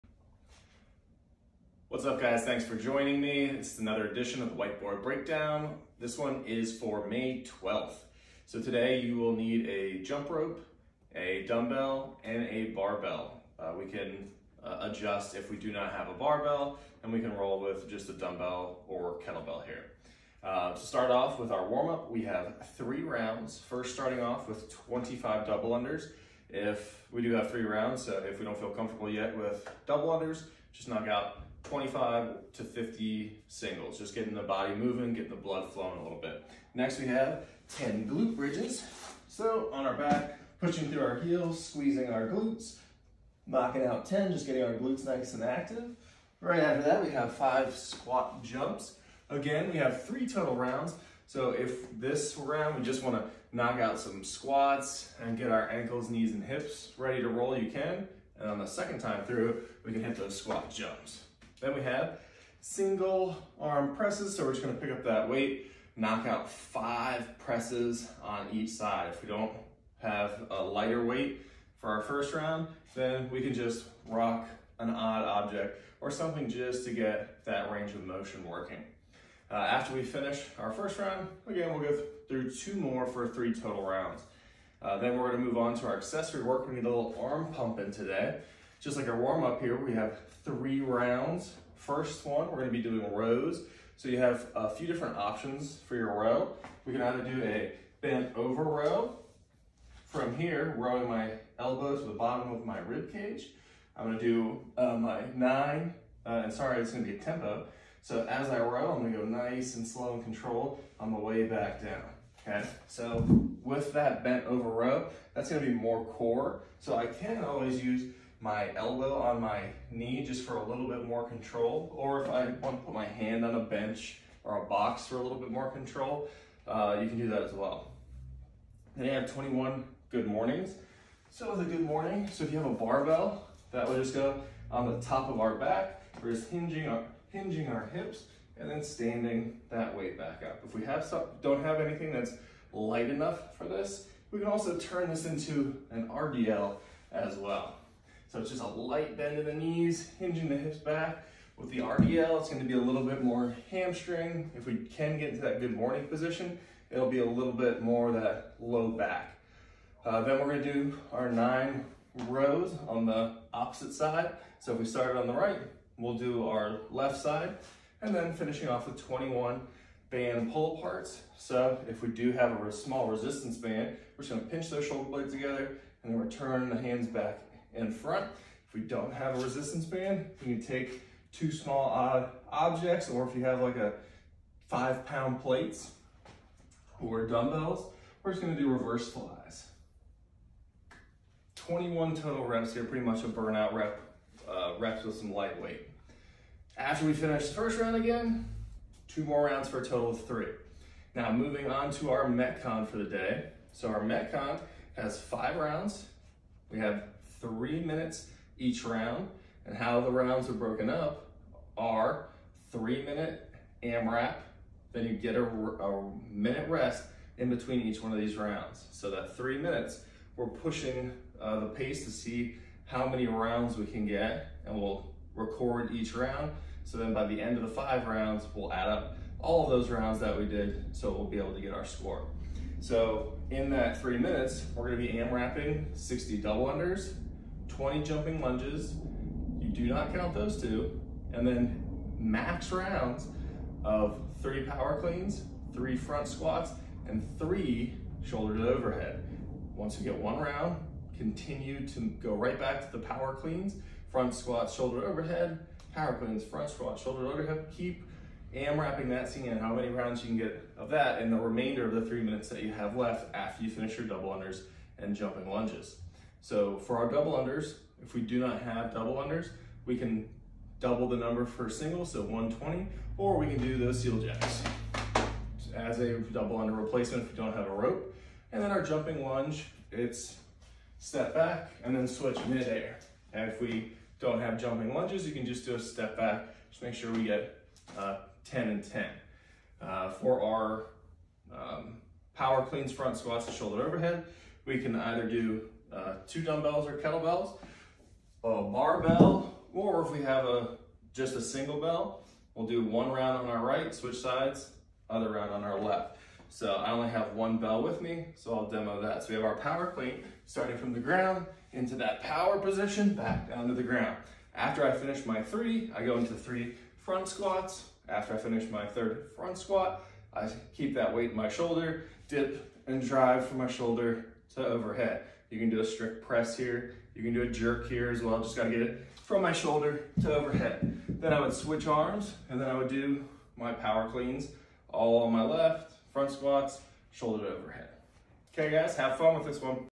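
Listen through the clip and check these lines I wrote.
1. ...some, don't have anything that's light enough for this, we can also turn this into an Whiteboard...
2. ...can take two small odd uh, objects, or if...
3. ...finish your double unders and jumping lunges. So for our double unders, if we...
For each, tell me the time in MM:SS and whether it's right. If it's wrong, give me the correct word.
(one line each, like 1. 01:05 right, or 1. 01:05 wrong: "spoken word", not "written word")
1. 02:21 wrong: "RDL", not "Whiteboard"
2. 03:00 right
3. 04:23 right.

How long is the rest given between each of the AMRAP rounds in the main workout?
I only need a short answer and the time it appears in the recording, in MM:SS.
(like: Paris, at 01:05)
a minute, at 03:35.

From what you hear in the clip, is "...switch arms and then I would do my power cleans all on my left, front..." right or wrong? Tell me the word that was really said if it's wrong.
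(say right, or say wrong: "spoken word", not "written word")
right.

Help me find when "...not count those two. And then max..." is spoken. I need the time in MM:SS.
03:59.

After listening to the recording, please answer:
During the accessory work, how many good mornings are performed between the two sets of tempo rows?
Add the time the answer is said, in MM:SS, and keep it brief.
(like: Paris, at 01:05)
21, at 02:09.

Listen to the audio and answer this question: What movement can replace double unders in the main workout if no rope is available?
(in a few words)
seal jacks.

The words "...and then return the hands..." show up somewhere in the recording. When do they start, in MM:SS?
02:56.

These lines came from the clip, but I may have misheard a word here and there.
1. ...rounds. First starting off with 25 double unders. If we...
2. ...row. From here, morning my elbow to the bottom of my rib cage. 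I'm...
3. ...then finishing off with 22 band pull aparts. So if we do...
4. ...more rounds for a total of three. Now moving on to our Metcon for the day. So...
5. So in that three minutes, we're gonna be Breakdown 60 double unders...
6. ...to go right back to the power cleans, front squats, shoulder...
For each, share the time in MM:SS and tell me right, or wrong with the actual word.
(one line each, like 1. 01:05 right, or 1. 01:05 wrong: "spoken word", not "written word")
1. 00:23 right
2. 01:38 wrong: "rowing", not "morning"
3. 02:48 wrong: "21", not "22"
4. 03:19 right
5. 03:52 wrong: "AMRAPing", not "Breakdown"
6. 04:11 right.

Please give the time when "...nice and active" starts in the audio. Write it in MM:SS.
00:45.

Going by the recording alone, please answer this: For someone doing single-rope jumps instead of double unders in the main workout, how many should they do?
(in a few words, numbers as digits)
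120.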